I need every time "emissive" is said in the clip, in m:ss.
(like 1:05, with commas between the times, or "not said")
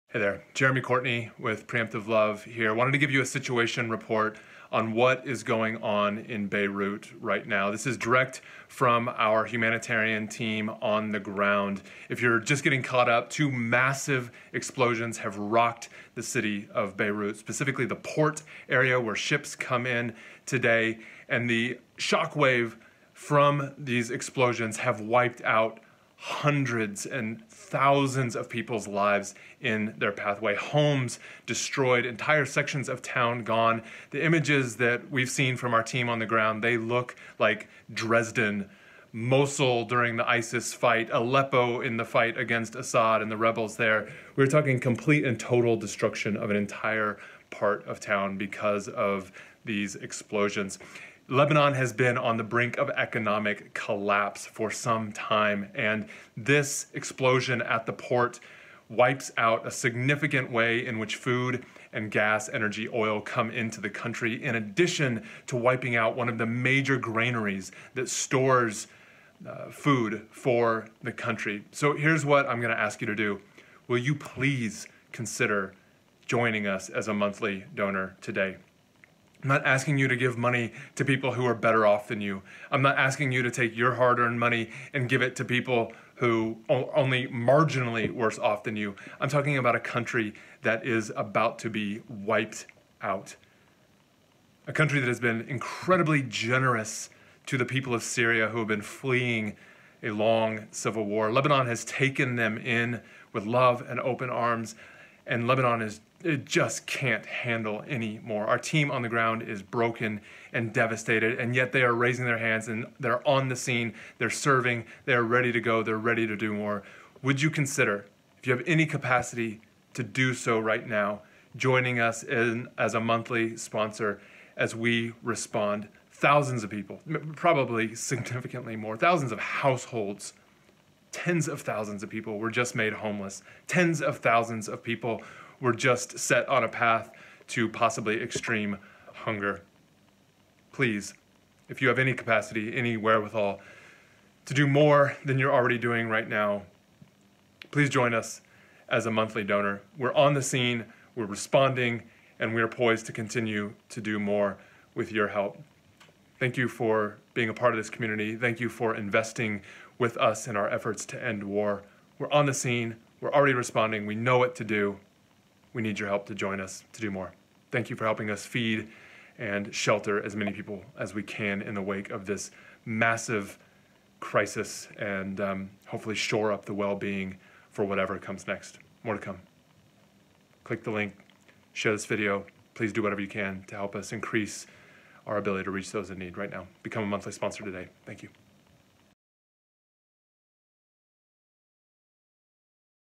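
not said.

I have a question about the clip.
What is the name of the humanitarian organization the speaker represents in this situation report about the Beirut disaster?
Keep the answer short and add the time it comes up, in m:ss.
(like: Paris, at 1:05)
Preemptive Love, at 0:01.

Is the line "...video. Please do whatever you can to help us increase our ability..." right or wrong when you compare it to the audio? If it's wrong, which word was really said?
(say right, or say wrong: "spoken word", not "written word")
right.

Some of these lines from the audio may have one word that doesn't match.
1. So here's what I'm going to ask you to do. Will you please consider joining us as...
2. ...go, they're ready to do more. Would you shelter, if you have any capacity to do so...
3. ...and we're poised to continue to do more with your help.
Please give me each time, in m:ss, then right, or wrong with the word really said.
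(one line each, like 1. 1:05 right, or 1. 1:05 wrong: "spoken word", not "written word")
1. 1:11 right
2. 1:55 wrong: "consider", not "shelter"
3. 2:32 right.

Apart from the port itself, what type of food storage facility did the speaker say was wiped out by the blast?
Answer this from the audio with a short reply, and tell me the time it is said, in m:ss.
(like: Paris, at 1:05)
Granaries, at 1:06.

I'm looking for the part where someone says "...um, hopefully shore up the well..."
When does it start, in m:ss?
2:55.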